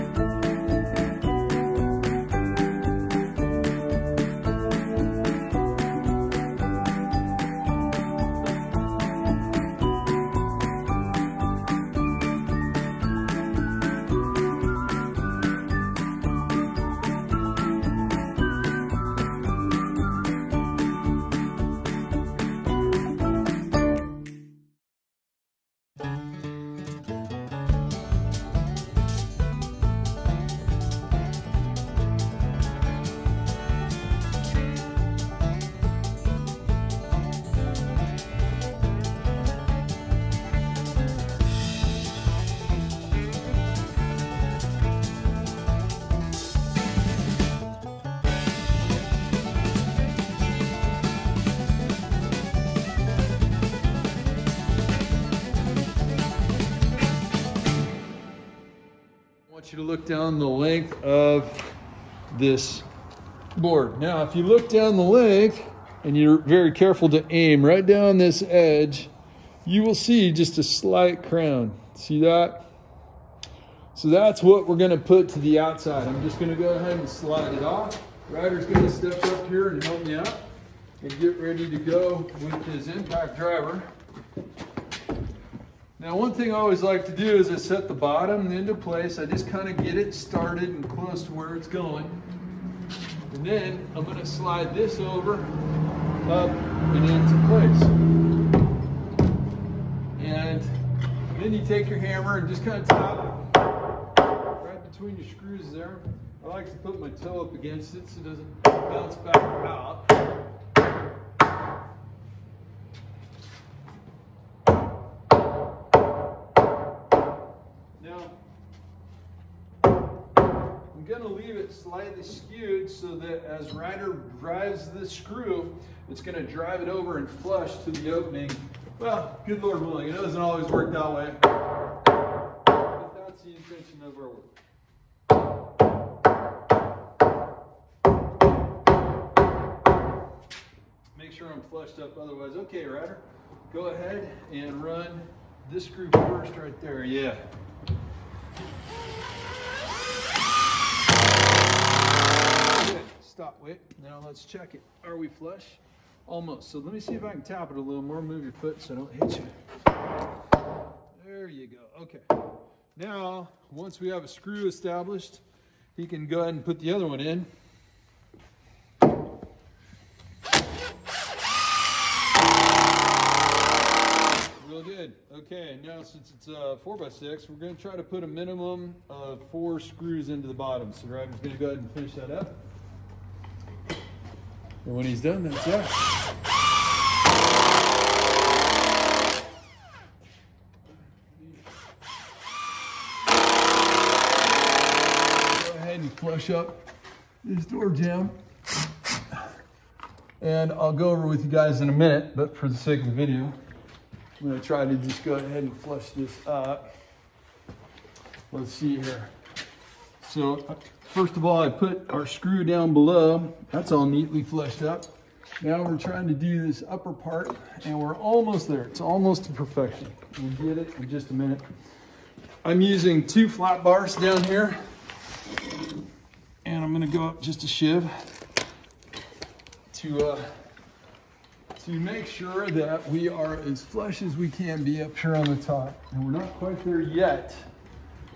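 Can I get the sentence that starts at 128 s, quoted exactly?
Well, good Lord willing, it doesn't always work that way.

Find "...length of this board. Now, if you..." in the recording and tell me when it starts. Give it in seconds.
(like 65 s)
60 s.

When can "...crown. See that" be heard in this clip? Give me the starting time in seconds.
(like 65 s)
71 s.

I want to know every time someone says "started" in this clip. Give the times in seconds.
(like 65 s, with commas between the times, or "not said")
90 s.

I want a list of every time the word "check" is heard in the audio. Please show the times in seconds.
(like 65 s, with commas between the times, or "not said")
154 s.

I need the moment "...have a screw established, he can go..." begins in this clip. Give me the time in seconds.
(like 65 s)
164 s.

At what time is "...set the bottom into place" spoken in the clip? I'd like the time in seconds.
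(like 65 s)
87 s.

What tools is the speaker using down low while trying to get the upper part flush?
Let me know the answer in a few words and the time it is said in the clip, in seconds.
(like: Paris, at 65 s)
two flat bars, at 223 s.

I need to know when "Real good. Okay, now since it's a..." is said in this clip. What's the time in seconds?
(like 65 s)
174 s.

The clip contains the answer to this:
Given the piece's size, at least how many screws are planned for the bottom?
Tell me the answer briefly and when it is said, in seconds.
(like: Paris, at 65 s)
4, at 179 s.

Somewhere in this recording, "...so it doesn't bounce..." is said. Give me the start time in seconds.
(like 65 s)
108 s.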